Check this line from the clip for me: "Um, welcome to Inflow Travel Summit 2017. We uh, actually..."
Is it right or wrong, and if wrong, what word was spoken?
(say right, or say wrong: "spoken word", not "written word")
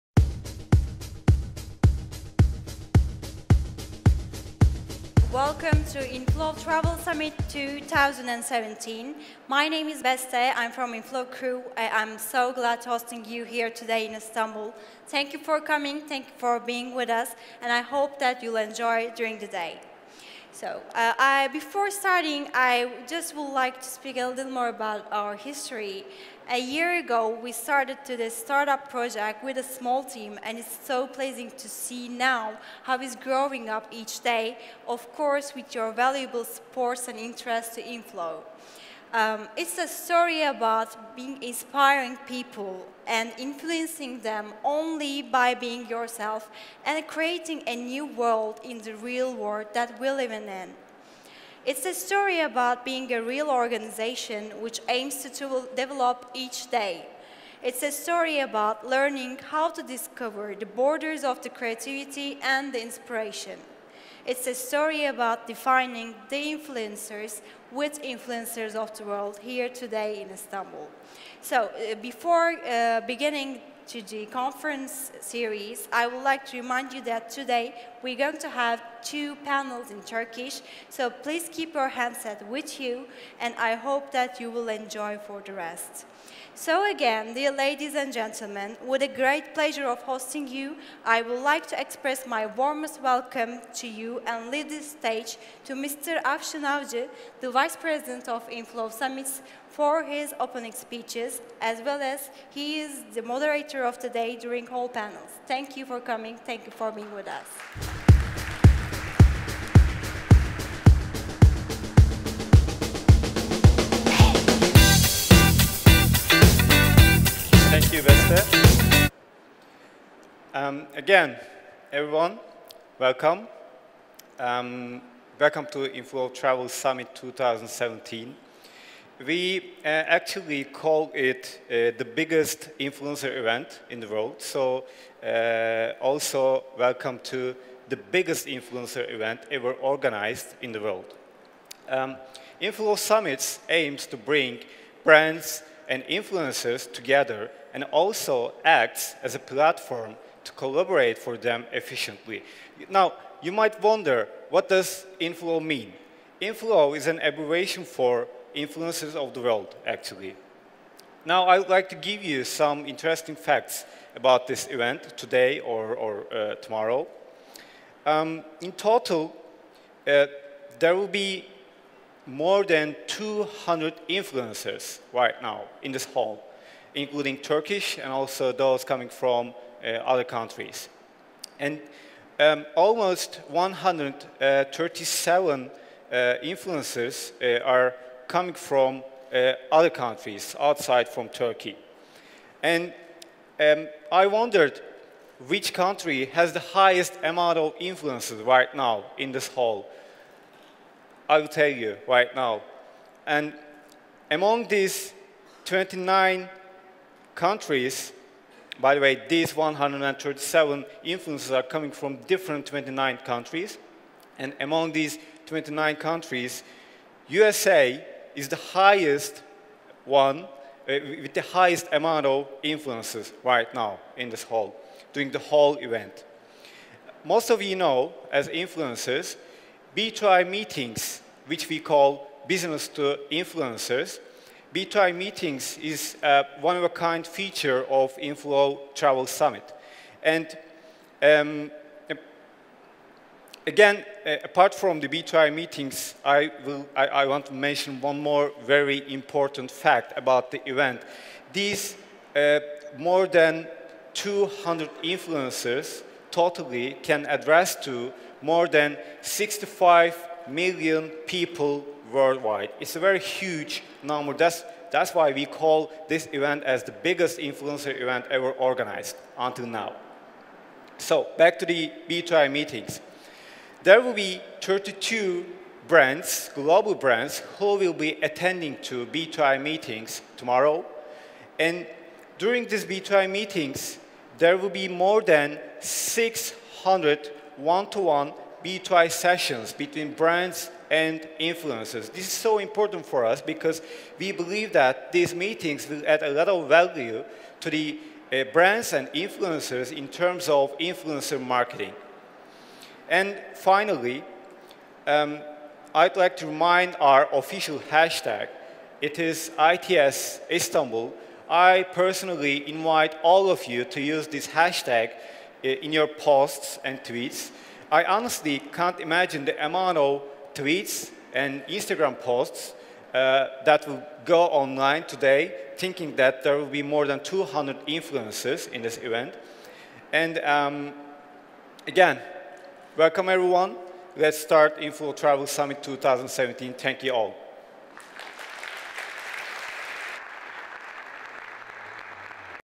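right.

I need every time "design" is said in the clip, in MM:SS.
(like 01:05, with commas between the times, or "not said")
not said.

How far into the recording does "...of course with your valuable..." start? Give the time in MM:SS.
00:34.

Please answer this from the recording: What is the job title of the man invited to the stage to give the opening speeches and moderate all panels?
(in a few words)
Vice President of Inflow Summits.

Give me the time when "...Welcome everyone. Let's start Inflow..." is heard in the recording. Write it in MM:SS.
05:32.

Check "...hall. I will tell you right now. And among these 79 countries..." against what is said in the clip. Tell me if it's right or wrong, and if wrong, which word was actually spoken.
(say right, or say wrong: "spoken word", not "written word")
wrong: "29", not "79".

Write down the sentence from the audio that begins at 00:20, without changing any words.
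So uh, I, before starting, I just would like to speak a little more about our history.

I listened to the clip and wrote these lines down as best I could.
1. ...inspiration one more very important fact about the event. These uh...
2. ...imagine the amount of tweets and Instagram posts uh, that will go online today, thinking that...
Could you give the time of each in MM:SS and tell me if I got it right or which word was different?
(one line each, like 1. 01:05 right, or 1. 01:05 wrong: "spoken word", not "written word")
1. 04:07 wrong: "mention", not "inspiration"
2. 05:19 right.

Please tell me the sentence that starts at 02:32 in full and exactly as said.
Now, you might wonder, what does inflow mean?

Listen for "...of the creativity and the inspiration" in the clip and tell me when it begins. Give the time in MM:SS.
01:01.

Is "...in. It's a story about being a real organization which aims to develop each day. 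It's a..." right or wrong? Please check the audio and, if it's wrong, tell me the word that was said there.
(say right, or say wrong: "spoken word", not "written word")
right.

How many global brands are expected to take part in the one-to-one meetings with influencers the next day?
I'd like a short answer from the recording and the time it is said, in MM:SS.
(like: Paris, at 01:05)
32, at 04:34.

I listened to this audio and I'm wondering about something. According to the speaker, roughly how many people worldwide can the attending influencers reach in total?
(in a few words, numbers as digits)
65 million.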